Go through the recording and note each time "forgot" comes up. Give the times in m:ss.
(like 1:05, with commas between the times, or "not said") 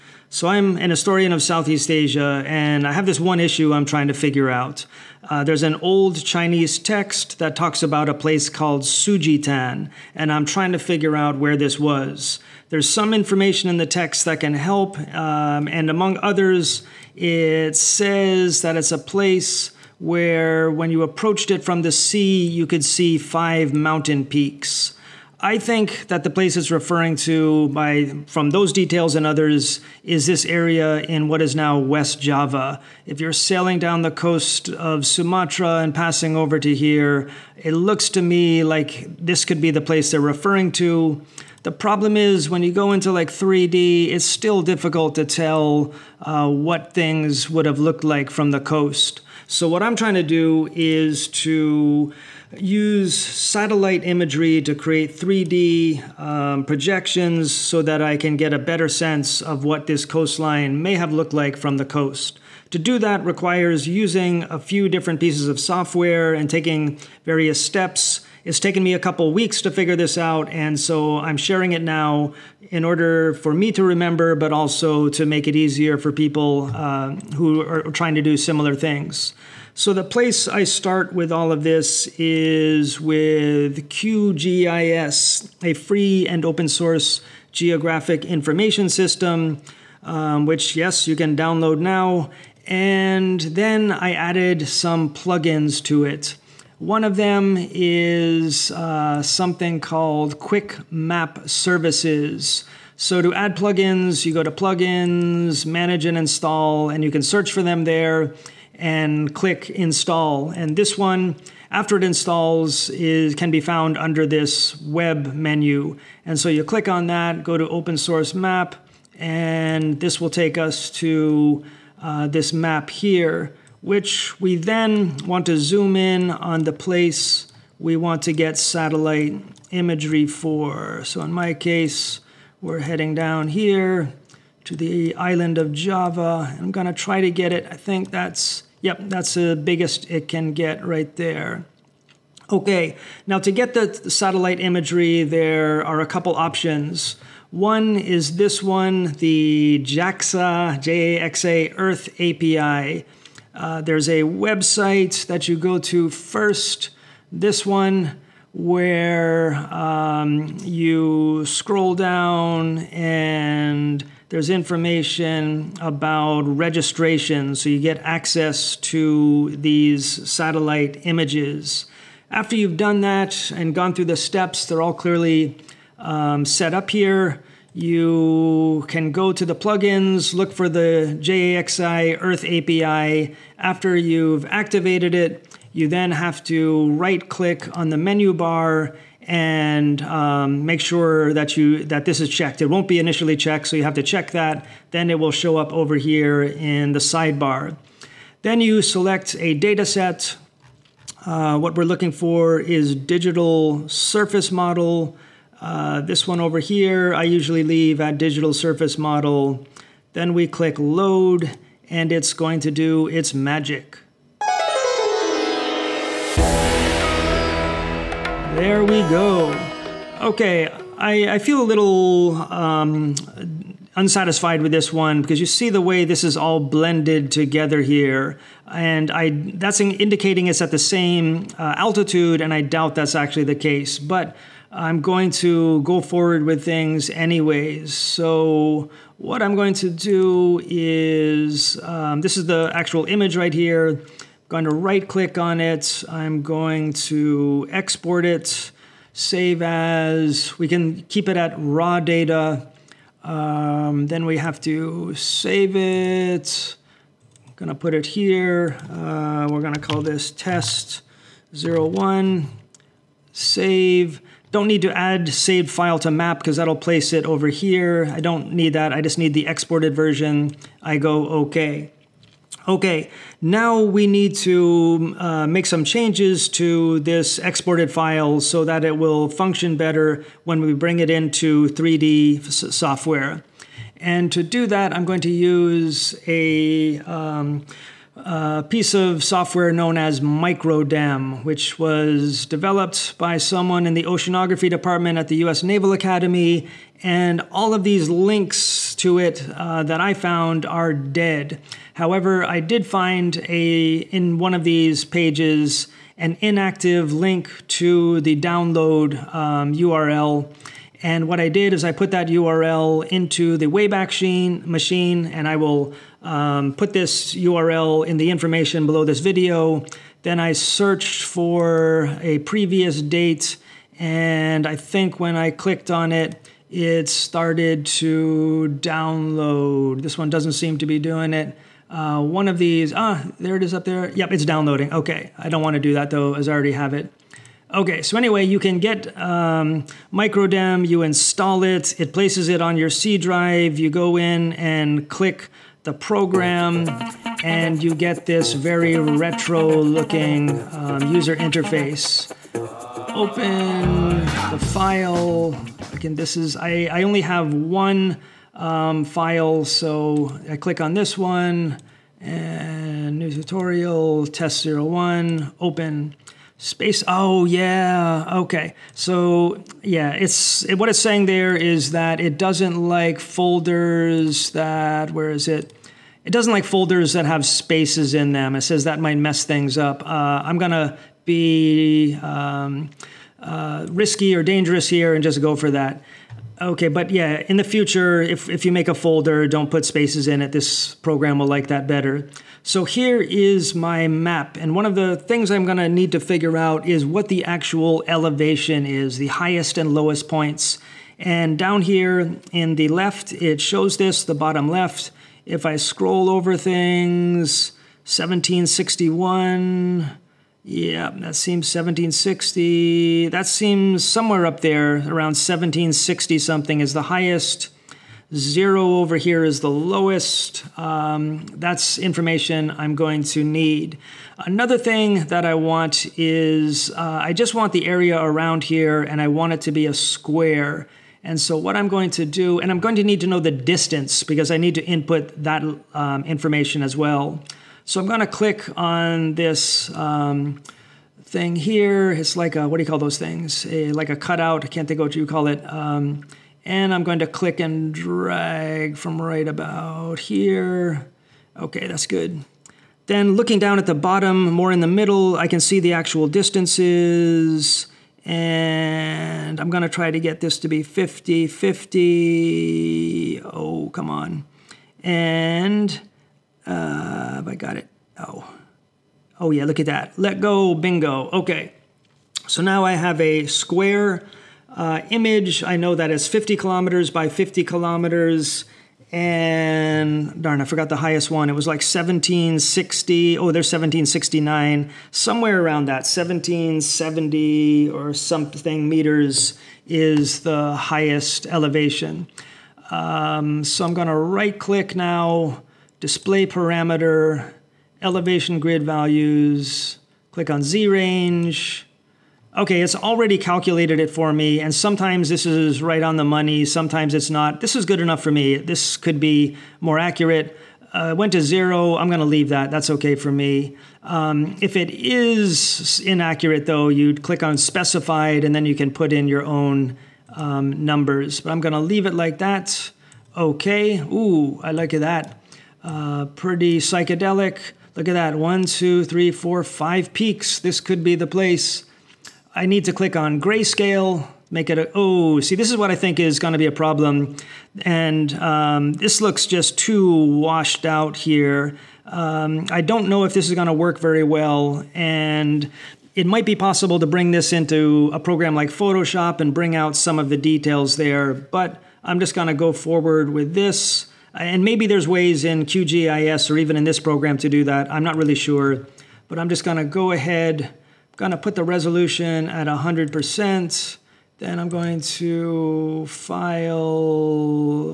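8:00.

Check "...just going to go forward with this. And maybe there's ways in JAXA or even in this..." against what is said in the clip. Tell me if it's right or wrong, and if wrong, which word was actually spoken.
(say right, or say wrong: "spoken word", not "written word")
wrong: "QGIS", not "JAXA".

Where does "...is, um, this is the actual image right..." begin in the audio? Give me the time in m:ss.
4:00.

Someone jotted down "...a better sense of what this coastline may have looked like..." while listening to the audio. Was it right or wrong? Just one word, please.
right.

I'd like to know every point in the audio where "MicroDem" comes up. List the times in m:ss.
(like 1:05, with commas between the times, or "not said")
4:50, 5:40.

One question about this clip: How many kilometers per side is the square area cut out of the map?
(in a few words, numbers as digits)
50.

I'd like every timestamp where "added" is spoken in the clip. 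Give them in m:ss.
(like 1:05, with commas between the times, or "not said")
1:34.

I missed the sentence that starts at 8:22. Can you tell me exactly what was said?
Okay, it's already calculated it for me, and sometimes this is right on the money, sometimes it's not.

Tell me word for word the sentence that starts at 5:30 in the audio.
This one doesn't seem to be doing it.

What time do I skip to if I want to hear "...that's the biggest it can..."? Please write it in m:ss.
2:19.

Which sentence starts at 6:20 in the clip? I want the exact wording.
Uh, I'm gonna be um, uh, risky or dangerous here and just go for that.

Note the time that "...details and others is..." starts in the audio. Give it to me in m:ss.
0:28.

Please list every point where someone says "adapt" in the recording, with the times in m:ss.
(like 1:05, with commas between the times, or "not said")
not said.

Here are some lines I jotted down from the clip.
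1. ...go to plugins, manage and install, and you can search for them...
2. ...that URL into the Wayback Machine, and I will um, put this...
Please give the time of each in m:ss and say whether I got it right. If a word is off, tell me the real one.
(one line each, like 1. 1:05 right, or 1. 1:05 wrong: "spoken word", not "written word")
1. 1:44 right
2. 5:12 right.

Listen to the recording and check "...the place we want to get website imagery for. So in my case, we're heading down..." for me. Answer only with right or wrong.
wrong.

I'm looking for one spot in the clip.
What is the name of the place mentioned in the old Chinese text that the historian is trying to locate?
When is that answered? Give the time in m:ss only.
0:08.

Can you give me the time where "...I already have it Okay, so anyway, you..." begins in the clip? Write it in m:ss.
5:36.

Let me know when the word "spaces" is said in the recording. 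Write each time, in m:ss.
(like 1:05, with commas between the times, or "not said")
6:06, 6:17, 6:29.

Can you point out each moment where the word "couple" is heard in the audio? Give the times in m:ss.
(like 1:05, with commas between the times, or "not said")
1:08, 2:26.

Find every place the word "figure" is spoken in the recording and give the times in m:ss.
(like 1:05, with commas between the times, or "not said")
0:04, 0:10, 1:09, 6:36.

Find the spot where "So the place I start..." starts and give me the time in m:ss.
1:19.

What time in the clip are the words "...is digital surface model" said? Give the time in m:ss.
3:22.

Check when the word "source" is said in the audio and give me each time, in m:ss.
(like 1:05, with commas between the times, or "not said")
1:26, 1:57.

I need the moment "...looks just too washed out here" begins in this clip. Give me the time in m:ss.
8:59.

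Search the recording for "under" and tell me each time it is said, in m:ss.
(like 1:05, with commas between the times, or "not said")
1:53.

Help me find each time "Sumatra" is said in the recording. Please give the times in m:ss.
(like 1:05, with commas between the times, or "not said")
0:35.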